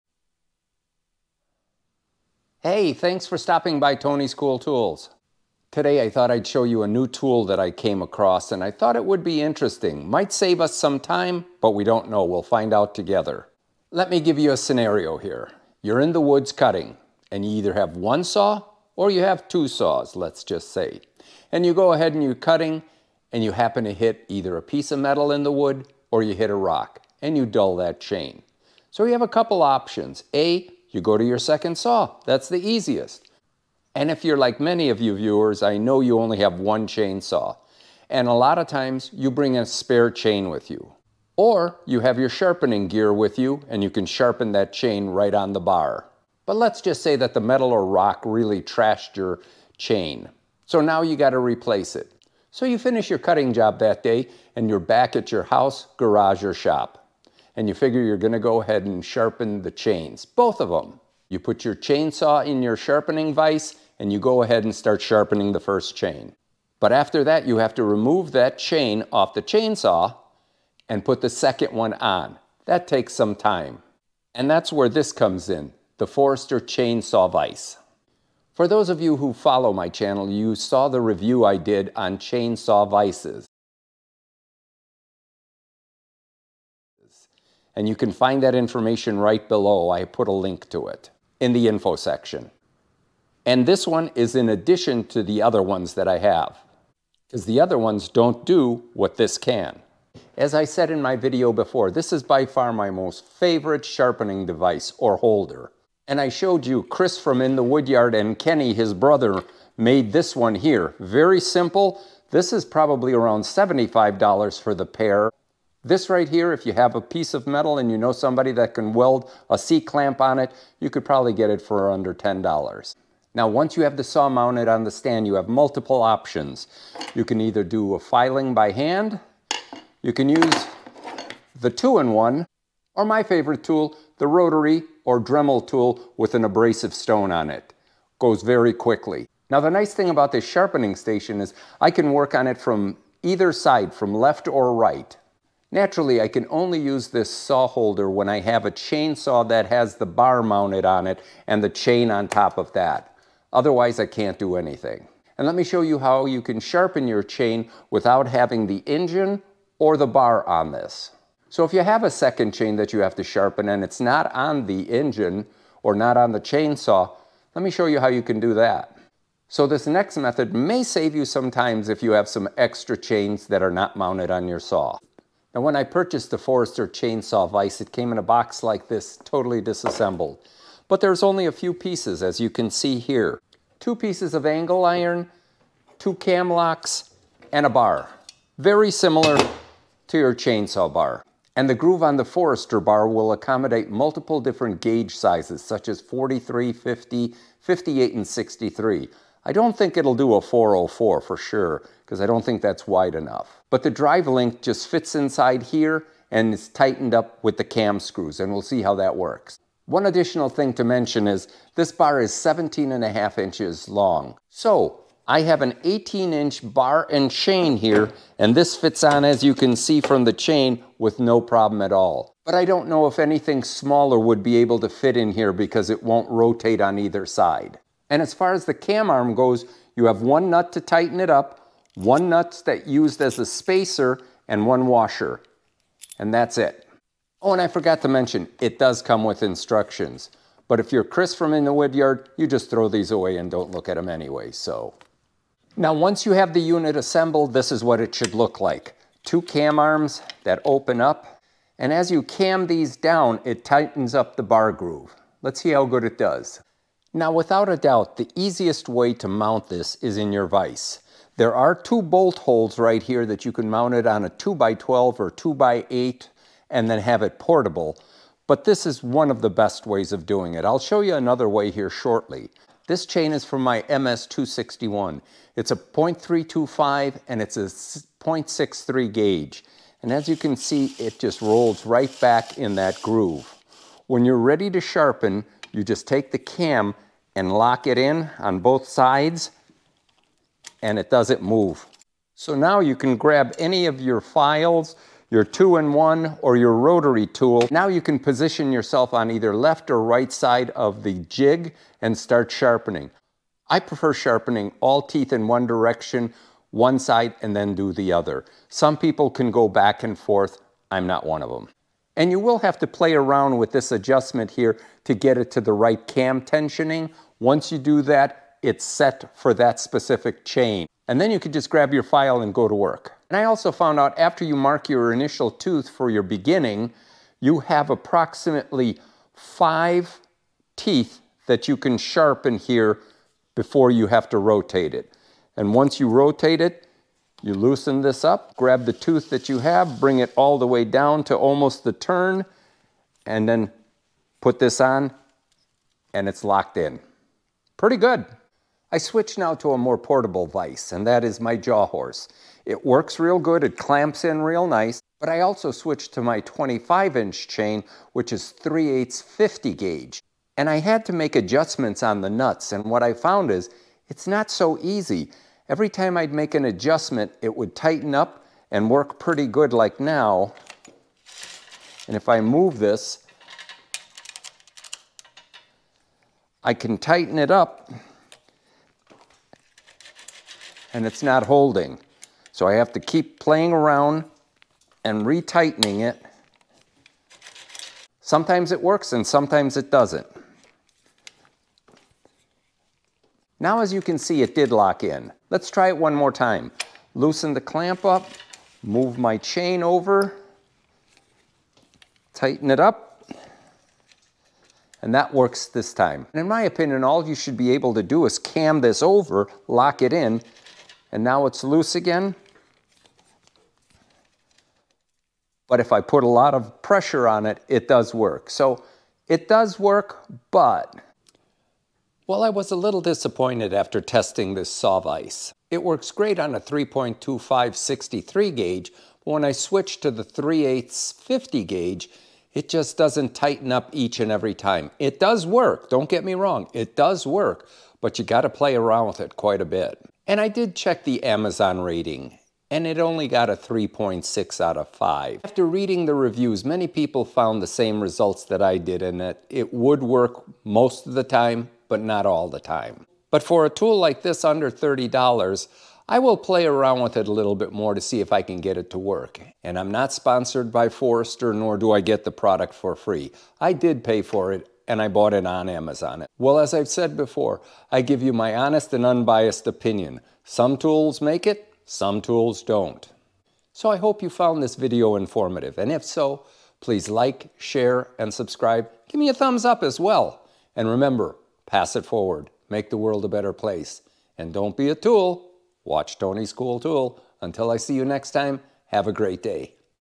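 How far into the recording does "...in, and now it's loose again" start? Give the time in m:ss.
6:50.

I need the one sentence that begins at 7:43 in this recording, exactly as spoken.
I did pay for it, and I bought it on Amazon.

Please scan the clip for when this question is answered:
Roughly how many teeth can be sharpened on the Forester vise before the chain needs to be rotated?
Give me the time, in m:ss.
5:29.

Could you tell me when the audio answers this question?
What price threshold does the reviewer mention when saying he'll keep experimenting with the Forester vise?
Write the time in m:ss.
7:34.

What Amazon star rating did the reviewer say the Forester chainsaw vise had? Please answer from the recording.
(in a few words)
3.6 out of 5.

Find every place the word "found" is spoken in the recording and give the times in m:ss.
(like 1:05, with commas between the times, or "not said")
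5:23, 6:03, 7:27, 7:54.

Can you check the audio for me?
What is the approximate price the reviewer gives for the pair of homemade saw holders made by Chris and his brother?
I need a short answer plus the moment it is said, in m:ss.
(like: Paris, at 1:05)
$75, at 1:53.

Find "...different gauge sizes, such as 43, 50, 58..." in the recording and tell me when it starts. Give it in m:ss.
3:14.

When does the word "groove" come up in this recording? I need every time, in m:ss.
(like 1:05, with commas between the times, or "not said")
3:11, 4:14, 4:43.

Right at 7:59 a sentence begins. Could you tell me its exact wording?
Give me a thumbs up as well.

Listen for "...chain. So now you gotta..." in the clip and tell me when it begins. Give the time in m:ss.
0:49.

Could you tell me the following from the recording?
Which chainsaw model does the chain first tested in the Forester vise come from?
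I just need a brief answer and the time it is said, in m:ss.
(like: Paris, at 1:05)
MS-261, at 4:33.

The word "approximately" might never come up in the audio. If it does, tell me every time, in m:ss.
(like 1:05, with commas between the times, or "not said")
5:27.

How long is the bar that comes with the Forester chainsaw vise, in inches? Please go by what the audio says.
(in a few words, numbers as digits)
17.5 inches.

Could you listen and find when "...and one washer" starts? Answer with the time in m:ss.
3:54.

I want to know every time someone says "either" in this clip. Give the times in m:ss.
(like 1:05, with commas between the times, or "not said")
0:17, 0:24, 2:07, 2:23, 3:46, 4:59.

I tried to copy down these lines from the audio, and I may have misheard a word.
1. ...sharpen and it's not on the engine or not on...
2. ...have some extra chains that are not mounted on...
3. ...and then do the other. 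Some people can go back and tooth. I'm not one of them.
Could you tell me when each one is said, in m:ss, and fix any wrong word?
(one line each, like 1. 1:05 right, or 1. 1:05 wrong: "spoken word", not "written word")
1. 2:43 right
2. 2:52 right
3. 5:07 wrong: "forth", not "tooth".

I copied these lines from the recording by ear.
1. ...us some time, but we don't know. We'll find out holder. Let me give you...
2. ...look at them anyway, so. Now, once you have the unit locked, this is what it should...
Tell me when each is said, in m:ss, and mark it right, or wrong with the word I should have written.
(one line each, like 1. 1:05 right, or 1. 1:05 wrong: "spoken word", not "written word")
1. 0:10 wrong: "together", not "holder"
2. 4:03 wrong: "assembled", not "locked".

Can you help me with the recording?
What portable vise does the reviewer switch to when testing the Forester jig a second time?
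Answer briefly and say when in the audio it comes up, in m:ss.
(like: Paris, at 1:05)
jaw horse, at 5:51.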